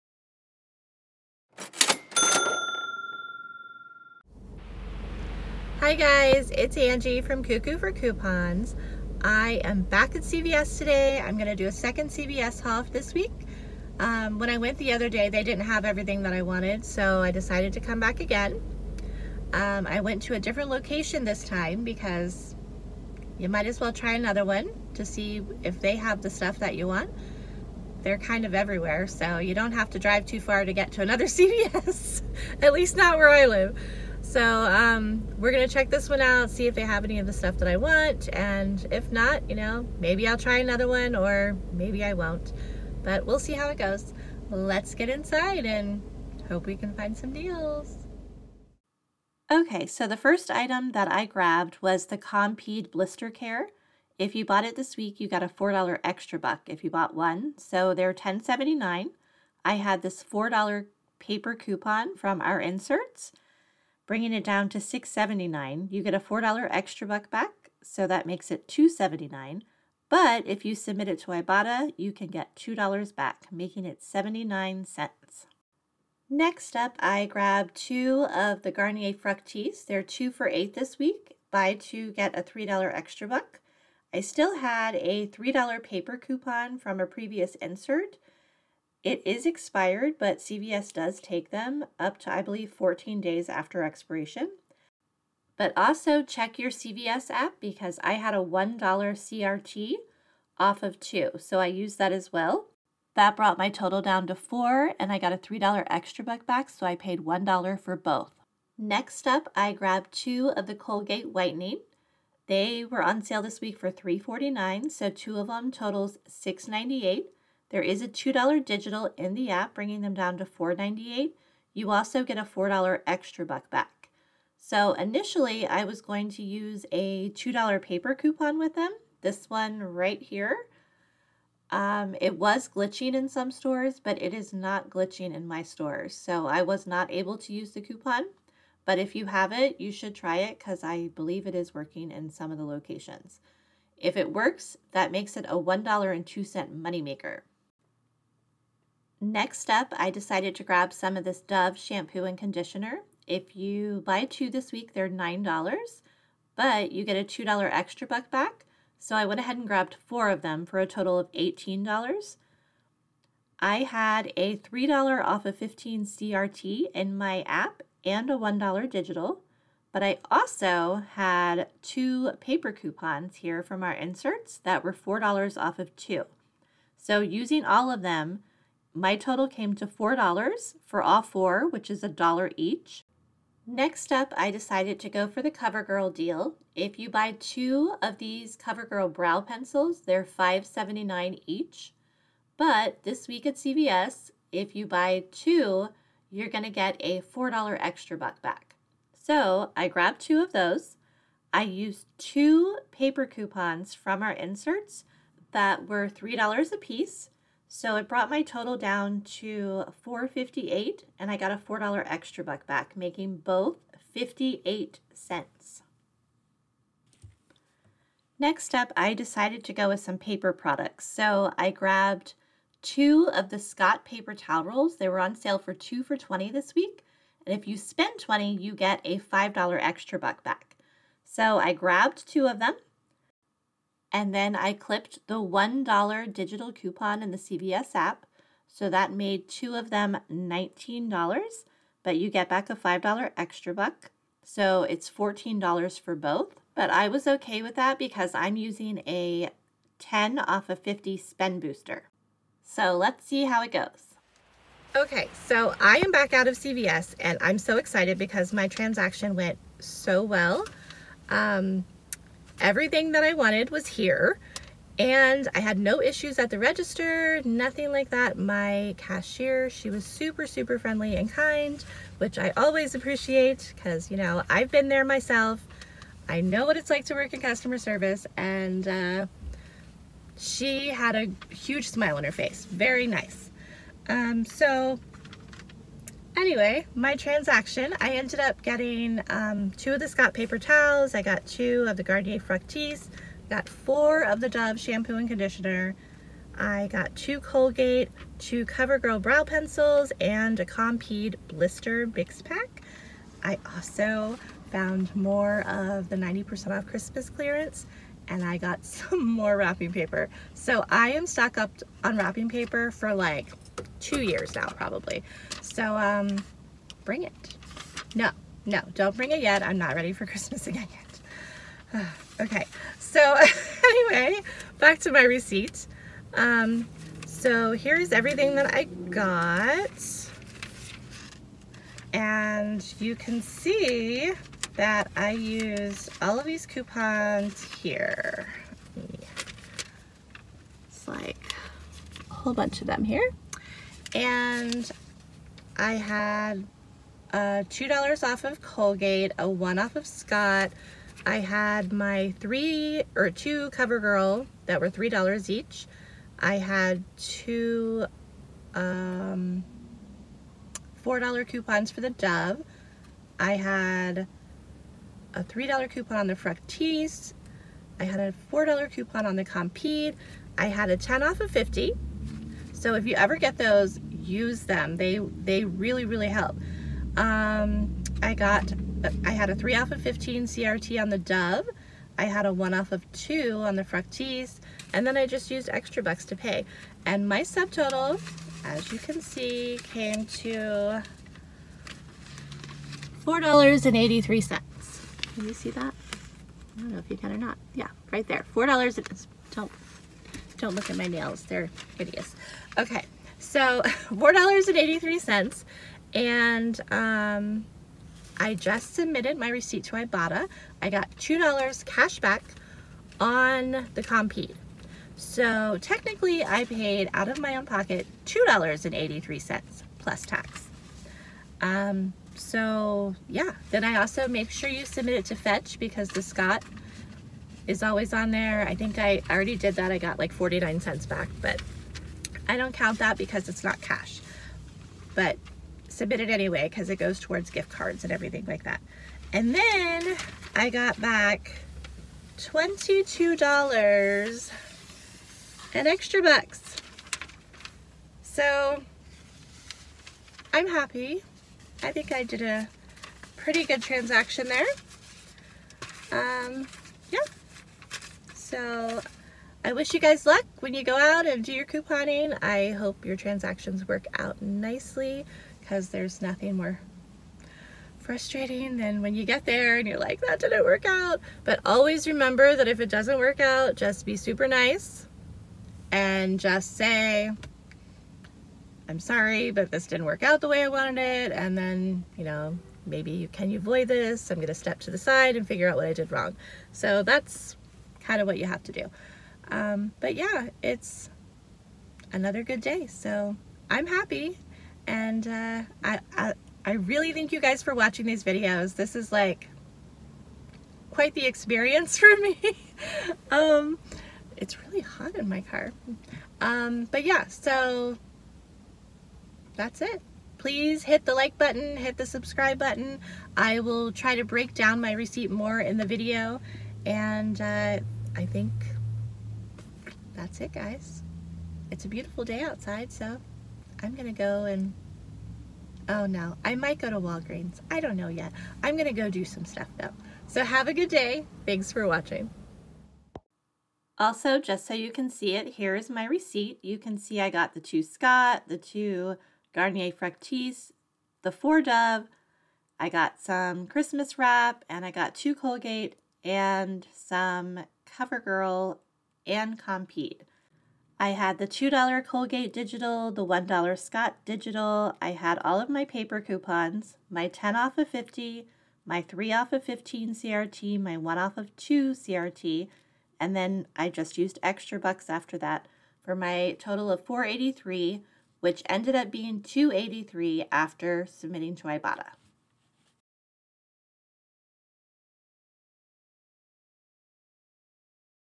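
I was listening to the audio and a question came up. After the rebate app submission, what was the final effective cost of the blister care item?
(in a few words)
79 cents.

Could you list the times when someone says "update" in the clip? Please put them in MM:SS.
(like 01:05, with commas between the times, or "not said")
not said.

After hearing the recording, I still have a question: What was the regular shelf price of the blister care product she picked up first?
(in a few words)
$10.79.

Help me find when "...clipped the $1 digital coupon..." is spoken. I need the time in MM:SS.
03:54.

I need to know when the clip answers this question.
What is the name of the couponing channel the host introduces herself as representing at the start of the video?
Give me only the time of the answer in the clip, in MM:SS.
00:07.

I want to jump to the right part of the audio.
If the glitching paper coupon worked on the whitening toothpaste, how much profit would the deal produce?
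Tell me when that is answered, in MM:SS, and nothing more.
02:25.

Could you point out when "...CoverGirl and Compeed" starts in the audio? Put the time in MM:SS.
09:07.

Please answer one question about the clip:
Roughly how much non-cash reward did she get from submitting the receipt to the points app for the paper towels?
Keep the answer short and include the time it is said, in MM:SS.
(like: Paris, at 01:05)
49 cents, at 07:10.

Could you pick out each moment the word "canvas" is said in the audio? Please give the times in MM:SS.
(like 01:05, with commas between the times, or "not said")
not said.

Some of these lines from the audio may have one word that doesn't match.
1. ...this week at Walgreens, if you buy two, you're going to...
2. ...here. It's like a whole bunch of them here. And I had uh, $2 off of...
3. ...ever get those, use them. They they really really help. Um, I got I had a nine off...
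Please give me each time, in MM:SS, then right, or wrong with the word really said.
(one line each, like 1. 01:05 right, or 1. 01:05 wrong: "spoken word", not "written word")
1. 03:13 wrong: "CVS", not "Walgreens"
2. 05:37 right
3. 06:13 wrong: "three", not "nine".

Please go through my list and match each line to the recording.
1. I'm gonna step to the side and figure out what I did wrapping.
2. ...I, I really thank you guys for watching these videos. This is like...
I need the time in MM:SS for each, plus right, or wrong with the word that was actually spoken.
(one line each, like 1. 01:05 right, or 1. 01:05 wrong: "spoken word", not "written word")
1. 08:04 wrong: "wrong", not "wrapping"
2. 08:16 right.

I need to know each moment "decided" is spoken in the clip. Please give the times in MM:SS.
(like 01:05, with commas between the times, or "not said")
00:17, 02:30, 03:04, 03:39.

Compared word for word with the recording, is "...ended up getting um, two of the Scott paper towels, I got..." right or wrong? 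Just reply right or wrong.
right.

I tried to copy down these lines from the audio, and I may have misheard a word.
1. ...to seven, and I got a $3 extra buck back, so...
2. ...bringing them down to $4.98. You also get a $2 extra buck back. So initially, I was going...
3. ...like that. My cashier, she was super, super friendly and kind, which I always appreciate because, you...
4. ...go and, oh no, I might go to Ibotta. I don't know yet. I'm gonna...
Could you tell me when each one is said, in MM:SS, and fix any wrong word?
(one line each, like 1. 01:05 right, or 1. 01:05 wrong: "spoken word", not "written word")
1. 01:44 wrong: "four", not "seven"
2. 01:59 wrong: "4", not "2"
3. 04:27 right
4. 08:44 wrong: "Walgreens", not "Ibotta".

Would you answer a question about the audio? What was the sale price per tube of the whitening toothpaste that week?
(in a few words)
$3.49.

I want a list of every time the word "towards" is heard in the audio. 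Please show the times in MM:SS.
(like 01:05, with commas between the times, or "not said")
07:17.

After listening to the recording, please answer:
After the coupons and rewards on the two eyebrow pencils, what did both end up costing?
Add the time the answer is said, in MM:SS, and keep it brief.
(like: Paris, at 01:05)
58 cents, at 03:34.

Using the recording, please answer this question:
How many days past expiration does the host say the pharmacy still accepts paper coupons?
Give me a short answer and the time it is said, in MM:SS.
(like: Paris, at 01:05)
14, at 01:32.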